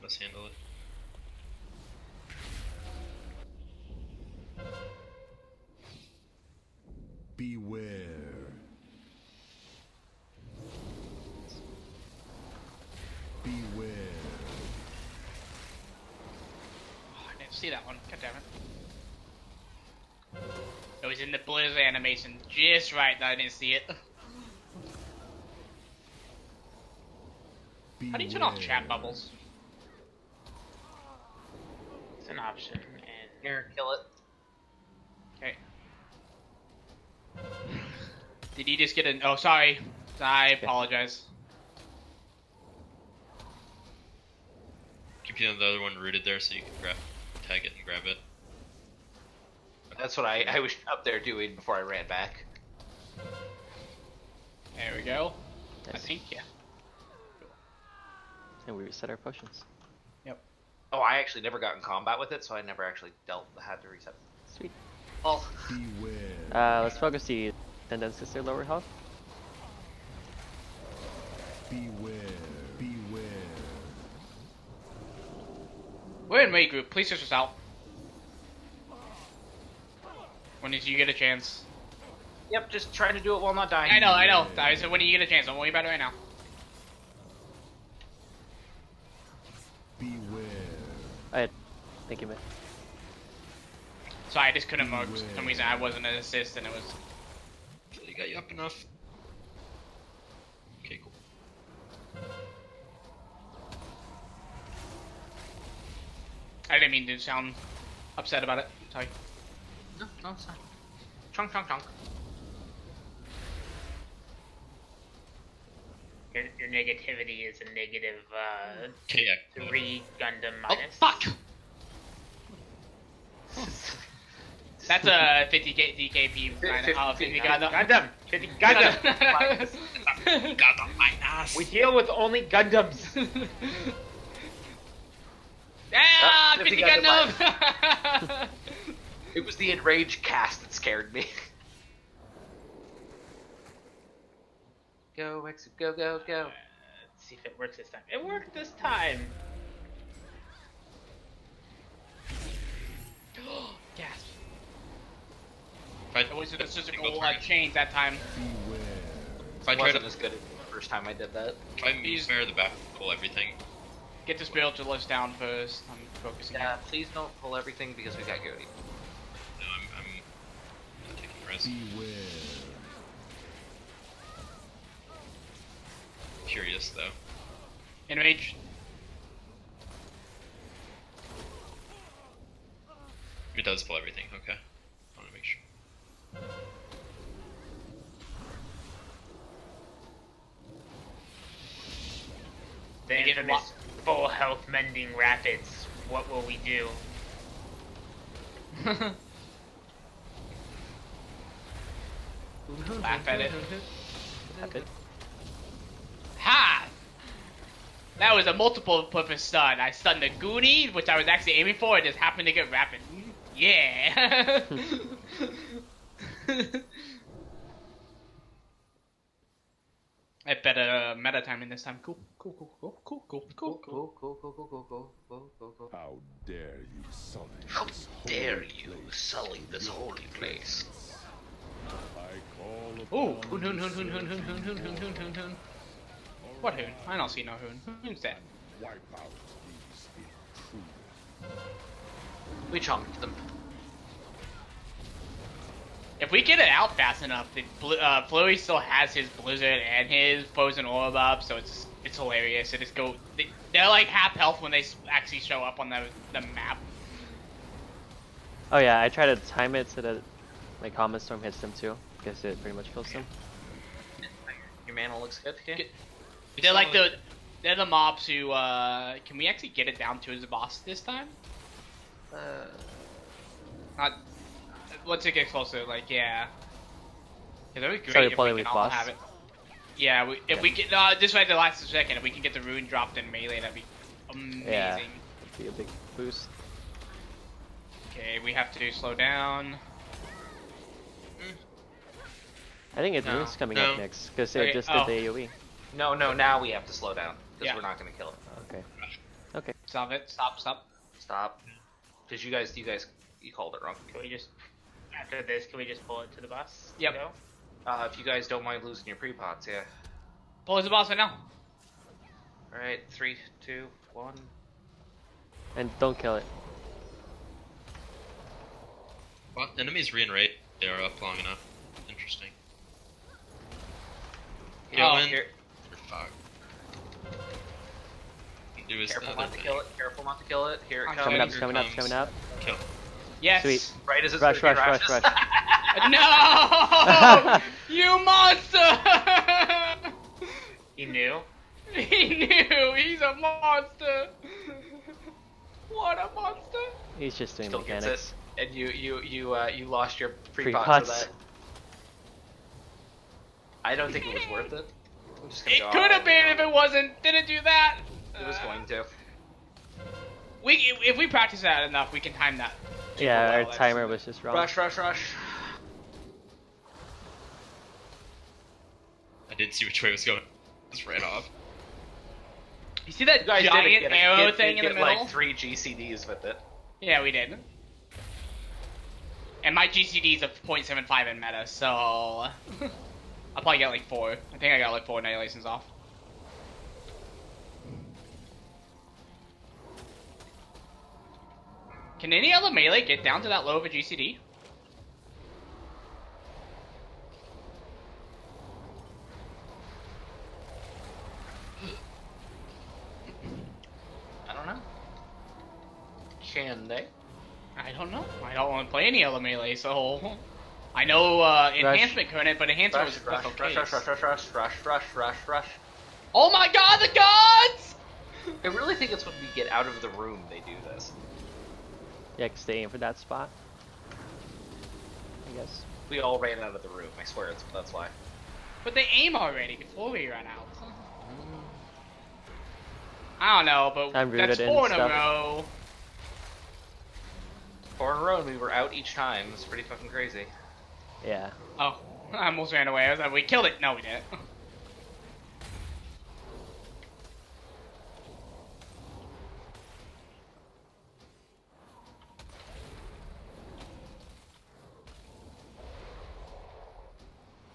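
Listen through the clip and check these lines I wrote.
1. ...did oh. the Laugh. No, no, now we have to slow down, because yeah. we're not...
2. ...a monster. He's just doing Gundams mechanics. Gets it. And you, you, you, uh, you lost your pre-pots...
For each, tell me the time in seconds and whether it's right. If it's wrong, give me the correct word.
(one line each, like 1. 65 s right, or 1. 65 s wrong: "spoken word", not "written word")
1. 294 s wrong: "AoE", not "Laugh"
2. 346 s wrong: "Still", not "Gundams".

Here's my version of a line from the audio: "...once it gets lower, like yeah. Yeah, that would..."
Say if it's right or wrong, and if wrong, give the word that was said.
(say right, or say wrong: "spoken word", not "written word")
wrong: "closer", not "lower".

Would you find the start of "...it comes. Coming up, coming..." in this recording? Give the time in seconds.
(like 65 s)
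331 s.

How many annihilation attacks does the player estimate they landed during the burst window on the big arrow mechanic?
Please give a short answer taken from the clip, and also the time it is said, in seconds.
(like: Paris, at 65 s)
4, at 385 s.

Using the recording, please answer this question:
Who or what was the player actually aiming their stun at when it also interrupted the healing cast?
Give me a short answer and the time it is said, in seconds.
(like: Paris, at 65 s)
The Goonie, at 210 s.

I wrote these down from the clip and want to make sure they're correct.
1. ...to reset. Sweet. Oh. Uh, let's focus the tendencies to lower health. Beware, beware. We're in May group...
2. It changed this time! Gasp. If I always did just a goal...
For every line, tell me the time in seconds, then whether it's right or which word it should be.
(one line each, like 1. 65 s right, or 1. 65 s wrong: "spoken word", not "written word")
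1. 63 s right
2. 148 s wrong: "worked", not "changed".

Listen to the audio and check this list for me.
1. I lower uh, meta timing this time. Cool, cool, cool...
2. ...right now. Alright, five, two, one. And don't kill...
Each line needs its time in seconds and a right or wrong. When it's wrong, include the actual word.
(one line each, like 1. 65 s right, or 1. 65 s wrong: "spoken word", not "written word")
1. 220 s wrong: "better", not "lower"
2. 311 s wrong: "three", not "five".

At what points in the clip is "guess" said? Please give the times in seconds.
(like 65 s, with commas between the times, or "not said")
262 s, 425 s.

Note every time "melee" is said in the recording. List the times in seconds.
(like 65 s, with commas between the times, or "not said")
283 s, 392 s, 409 s.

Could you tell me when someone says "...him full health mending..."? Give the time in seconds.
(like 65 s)
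193 s.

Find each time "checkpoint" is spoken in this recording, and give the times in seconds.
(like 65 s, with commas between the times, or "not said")
not said.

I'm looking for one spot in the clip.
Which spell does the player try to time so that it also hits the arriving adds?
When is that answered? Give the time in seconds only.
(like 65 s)
260 s.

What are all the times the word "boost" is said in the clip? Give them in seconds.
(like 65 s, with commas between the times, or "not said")
286 s.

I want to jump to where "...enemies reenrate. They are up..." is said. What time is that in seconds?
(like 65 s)
319 s.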